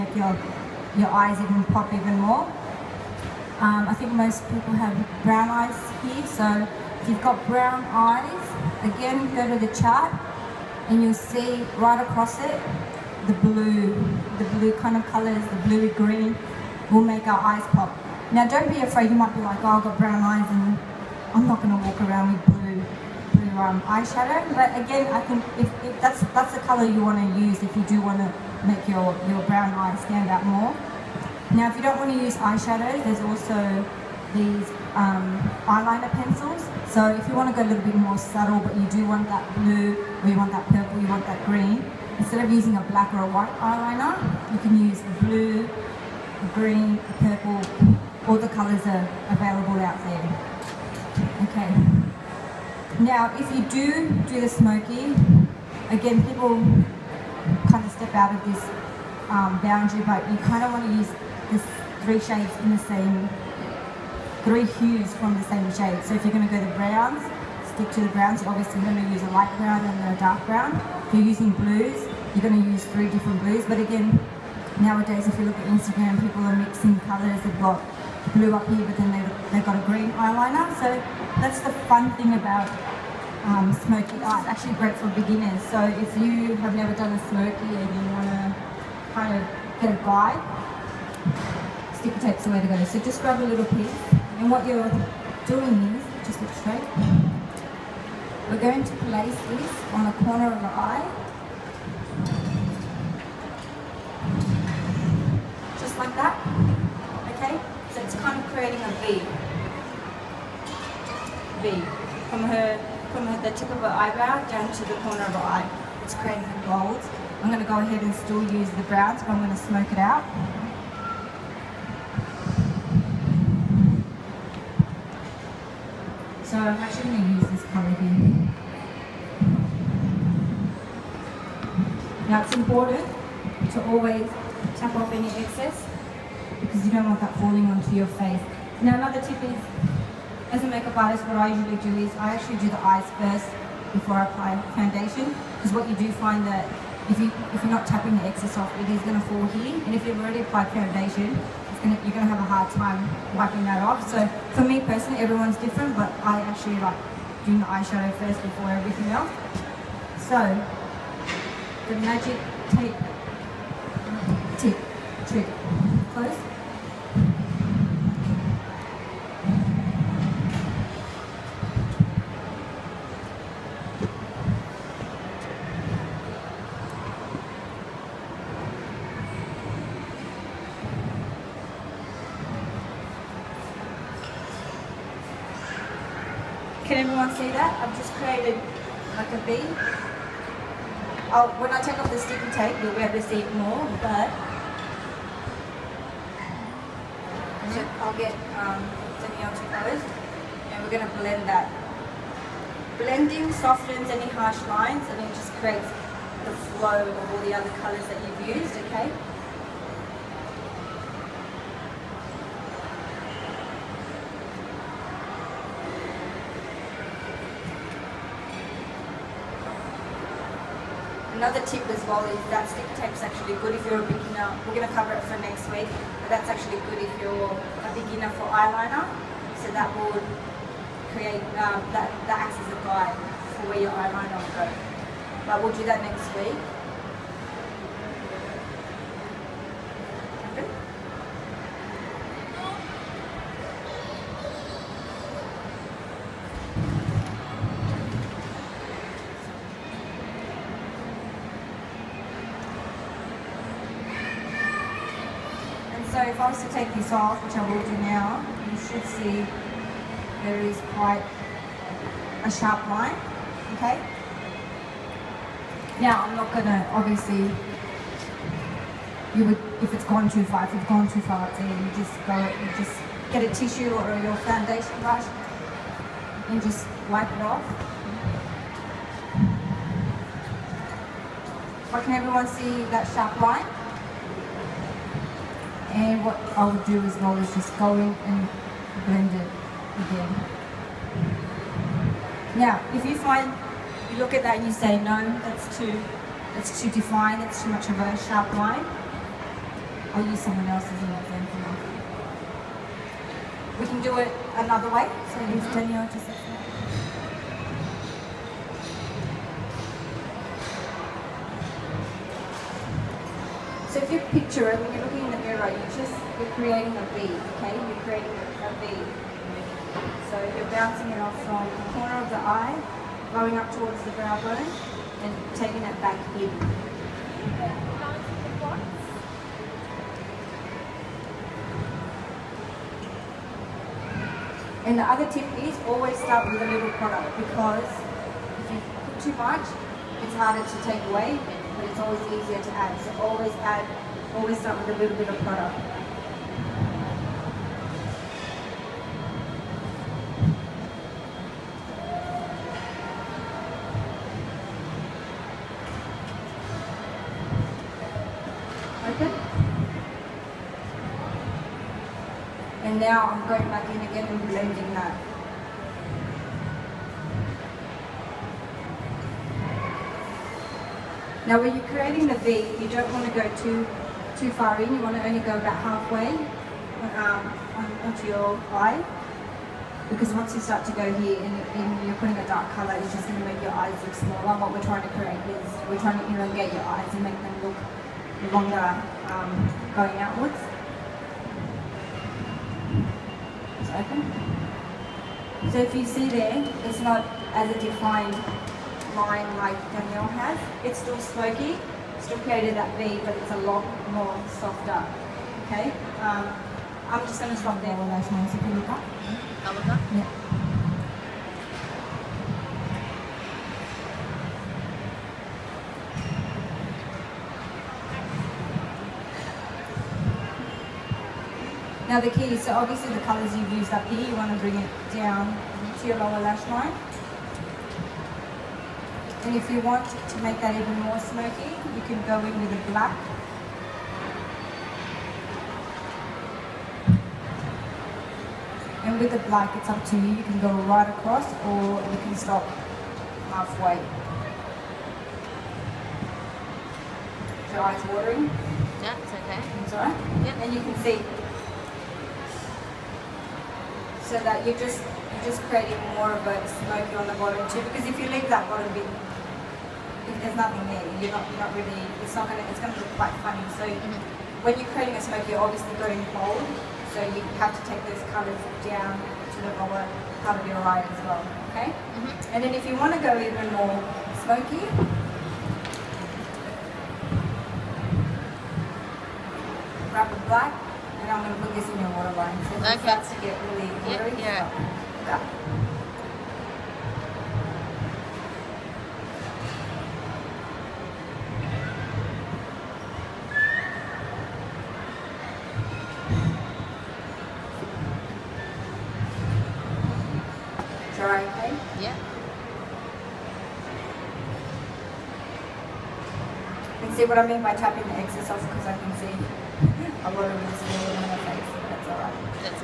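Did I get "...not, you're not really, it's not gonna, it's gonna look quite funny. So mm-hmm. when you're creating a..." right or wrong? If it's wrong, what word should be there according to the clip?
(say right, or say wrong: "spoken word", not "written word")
right.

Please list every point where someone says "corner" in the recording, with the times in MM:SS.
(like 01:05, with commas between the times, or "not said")
01:40, 01:54, 05:21.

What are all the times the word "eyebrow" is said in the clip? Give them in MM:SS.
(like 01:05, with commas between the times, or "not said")
01:53.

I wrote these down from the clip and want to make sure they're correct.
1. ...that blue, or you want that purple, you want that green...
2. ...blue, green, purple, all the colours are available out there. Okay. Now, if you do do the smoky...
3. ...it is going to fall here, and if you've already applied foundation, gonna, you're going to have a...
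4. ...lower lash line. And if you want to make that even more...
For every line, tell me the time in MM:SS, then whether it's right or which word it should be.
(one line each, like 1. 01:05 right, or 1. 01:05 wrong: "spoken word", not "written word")
1. 00:39 right
2. 00:45 right
3. 02:28 right
4. 07:06 right.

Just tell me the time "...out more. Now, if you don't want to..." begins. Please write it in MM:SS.
00:30.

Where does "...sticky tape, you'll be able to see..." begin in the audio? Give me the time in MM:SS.
03:12.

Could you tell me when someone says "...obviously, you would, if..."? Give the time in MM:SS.
04:26.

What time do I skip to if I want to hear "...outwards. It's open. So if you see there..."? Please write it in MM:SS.
06:30.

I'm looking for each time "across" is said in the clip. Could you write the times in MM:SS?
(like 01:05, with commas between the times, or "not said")
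00:12, 07:21.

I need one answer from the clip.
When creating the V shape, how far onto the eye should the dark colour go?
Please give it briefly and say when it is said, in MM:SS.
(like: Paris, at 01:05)
about halfway, at 06:15.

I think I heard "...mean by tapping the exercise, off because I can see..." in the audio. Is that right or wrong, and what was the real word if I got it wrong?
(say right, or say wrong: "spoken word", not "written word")
right.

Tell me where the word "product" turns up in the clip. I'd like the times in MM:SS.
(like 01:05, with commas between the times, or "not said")
05:37, 05:45.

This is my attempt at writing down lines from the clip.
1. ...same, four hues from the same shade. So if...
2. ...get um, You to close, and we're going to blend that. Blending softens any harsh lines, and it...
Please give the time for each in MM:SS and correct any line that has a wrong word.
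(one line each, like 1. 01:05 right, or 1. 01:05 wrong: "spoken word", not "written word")
1. 01:02 wrong: "three", not "four"
2. 03:18 wrong: "Danielle", not "You".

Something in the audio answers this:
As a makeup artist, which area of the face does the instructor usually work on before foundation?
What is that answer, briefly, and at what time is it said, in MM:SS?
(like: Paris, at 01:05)
the eyes, at 02:22.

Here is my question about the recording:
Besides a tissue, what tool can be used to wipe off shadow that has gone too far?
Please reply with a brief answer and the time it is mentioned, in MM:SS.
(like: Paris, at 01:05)
foundation brush, at 04:34.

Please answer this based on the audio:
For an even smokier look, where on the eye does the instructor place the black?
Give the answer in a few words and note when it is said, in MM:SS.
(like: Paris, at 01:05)
waterline, at 08:02.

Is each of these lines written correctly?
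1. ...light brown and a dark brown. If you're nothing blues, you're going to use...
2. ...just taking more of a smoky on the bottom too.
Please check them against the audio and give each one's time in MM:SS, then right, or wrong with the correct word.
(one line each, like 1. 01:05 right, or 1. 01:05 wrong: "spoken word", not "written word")
1. 01:09 wrong: "using", not "nothing"
2. 07:35 wrong: "creating", not "taking".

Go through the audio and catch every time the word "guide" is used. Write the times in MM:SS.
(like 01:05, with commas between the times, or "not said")
01:30, 03:52.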